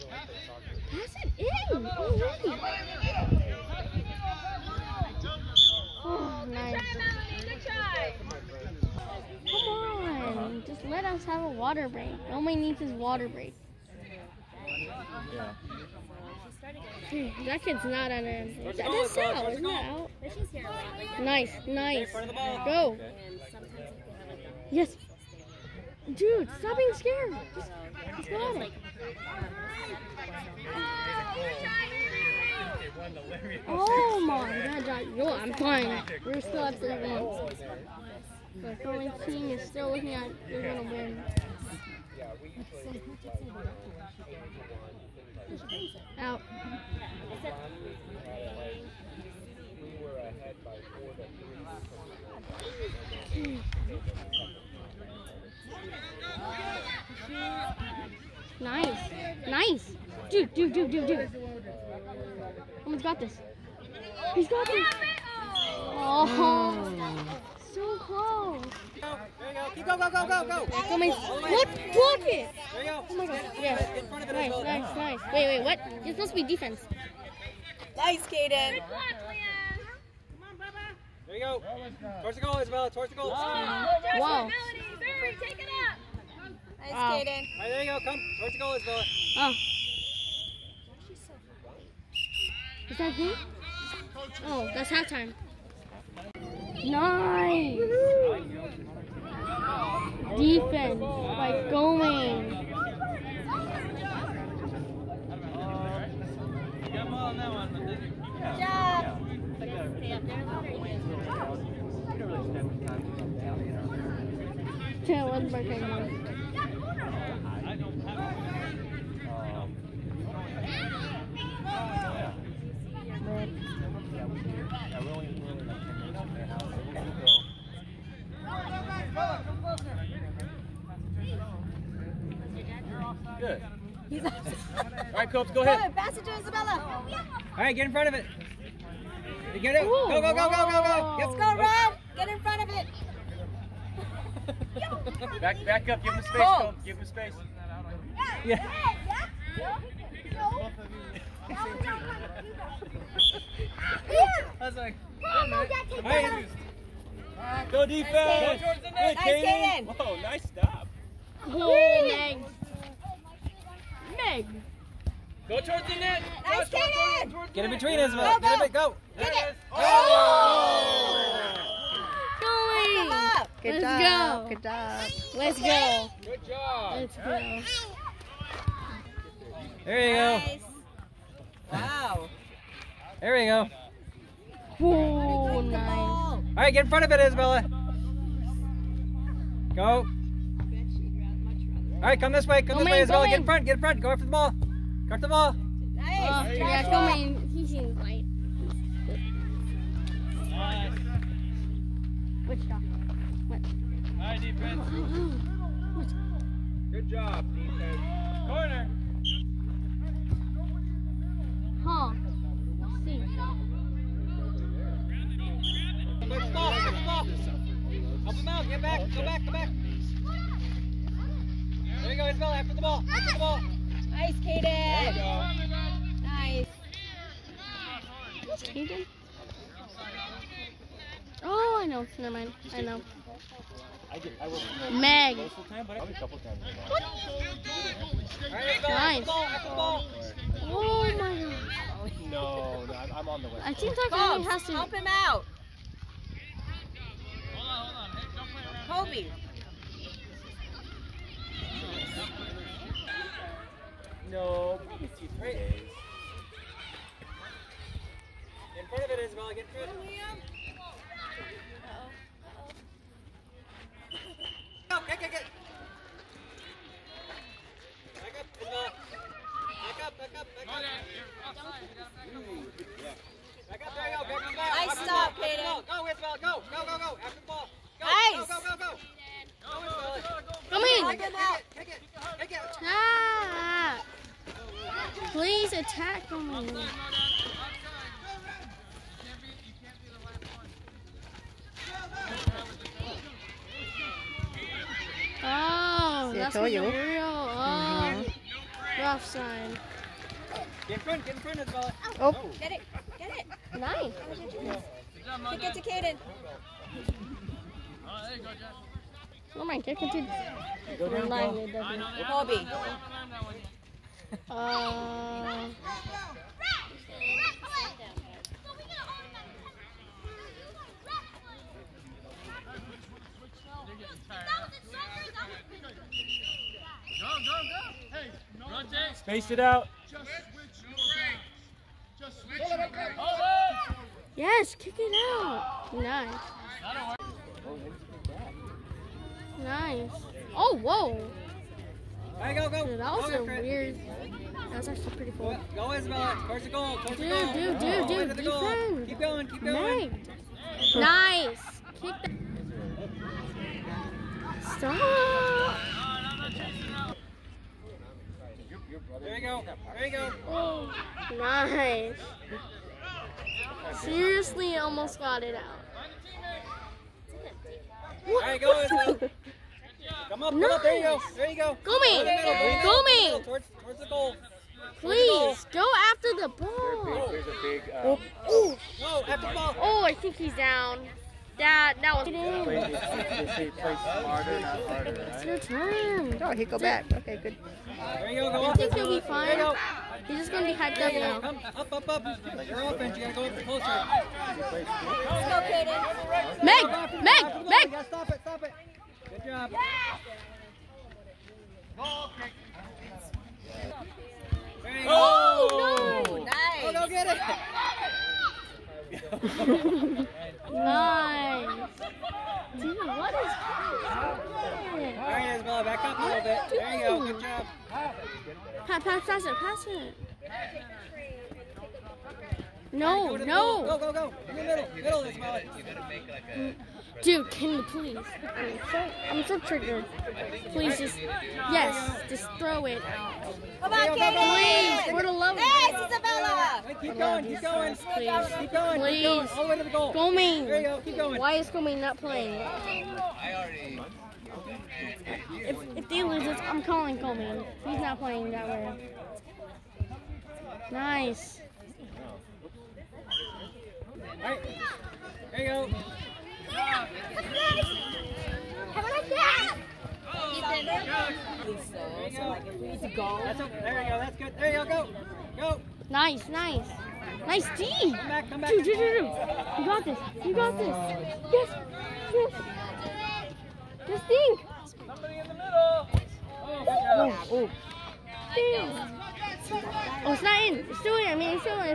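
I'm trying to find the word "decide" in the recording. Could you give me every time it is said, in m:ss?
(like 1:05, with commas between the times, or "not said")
not said.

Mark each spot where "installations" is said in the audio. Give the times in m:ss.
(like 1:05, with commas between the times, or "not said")
not said.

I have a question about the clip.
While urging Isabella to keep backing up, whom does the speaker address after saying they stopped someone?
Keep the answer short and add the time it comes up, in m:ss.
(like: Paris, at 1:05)
Peyton, at 4:35.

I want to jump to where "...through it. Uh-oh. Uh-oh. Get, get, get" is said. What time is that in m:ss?
4:19.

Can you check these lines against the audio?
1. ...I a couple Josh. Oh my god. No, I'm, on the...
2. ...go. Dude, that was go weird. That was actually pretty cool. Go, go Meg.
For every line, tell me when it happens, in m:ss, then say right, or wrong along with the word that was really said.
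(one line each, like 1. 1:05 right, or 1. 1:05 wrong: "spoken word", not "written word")
1. 3:55 wrong: "Nice", not "Josh"
2. 5:42 wrong: "Isabella", not "Meg".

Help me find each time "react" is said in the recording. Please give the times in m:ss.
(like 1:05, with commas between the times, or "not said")
not said.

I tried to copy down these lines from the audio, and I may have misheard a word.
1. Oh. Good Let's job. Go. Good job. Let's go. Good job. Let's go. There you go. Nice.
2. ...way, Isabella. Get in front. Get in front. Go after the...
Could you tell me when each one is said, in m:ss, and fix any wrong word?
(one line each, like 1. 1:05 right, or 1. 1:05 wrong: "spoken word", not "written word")
1. 2:53 right
2. 3:12 right.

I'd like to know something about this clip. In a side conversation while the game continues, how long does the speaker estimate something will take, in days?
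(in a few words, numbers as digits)
2 or 3 days.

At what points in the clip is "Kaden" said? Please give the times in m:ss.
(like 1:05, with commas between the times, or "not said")
1:18, 1:26, 2:39, 2:46, 3:44, 3:48, 6:35.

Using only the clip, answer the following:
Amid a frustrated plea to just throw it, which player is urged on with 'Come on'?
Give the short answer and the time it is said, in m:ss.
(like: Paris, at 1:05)
Katie, at 7:14.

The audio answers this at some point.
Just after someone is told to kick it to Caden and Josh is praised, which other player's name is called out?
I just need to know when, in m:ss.
5:12.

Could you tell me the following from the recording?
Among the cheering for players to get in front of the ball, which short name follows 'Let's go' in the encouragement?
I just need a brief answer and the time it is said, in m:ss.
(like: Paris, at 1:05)
Rob, at 2:21.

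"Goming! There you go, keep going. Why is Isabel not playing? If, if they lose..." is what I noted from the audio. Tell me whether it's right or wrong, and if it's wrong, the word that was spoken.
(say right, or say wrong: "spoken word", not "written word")
wrong: "Goming", not "Isabel".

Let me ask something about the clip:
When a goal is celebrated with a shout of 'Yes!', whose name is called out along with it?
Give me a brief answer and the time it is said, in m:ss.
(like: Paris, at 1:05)
Craig, at 6:42.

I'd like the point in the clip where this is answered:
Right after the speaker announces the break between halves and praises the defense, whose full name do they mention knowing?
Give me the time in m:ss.
1:55.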